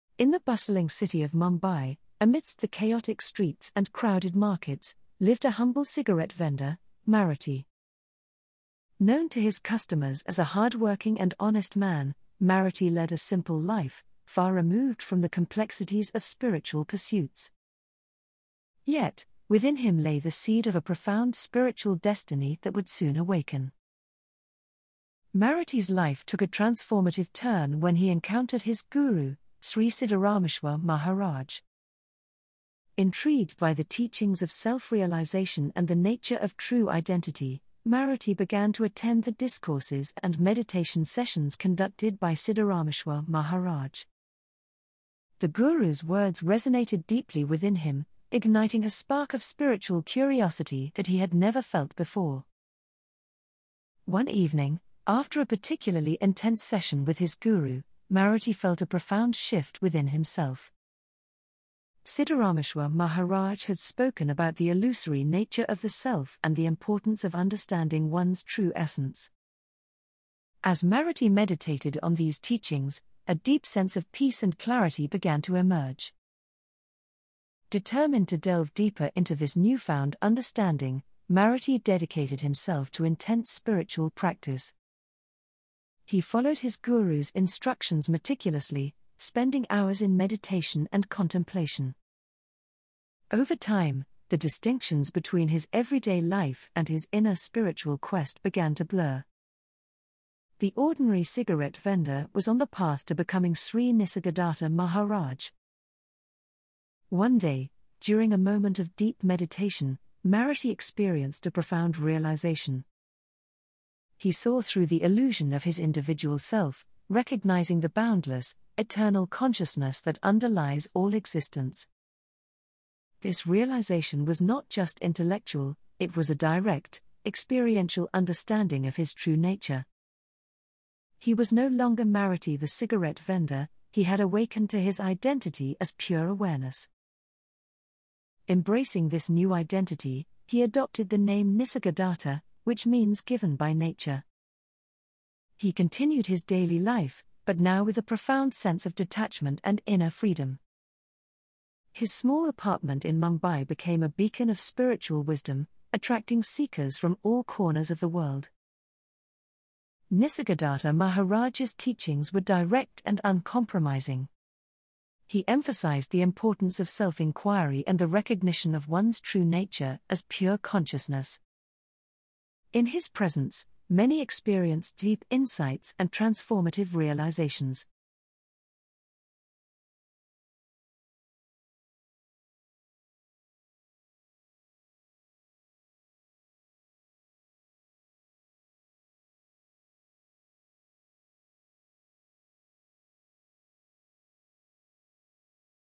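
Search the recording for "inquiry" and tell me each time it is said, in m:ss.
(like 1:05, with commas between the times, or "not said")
2:47.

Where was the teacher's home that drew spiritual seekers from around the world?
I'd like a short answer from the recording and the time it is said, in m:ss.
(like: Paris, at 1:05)
Small apartment in Mumbai, at 2:32.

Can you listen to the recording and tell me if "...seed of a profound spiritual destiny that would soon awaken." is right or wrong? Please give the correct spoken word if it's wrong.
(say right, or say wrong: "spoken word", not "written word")
right.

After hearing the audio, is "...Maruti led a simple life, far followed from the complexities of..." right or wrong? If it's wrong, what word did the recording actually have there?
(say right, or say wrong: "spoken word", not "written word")
wrong: "removed", not "followed".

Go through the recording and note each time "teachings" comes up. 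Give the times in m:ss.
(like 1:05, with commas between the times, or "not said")
0:33, 1:12, 2:41.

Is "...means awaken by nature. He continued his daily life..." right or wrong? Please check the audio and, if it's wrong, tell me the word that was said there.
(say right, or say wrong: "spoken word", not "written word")
wrong: "given", not "awaken".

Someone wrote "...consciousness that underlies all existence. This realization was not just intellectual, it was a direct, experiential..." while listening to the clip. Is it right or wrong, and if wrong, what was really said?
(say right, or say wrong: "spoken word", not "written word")
right.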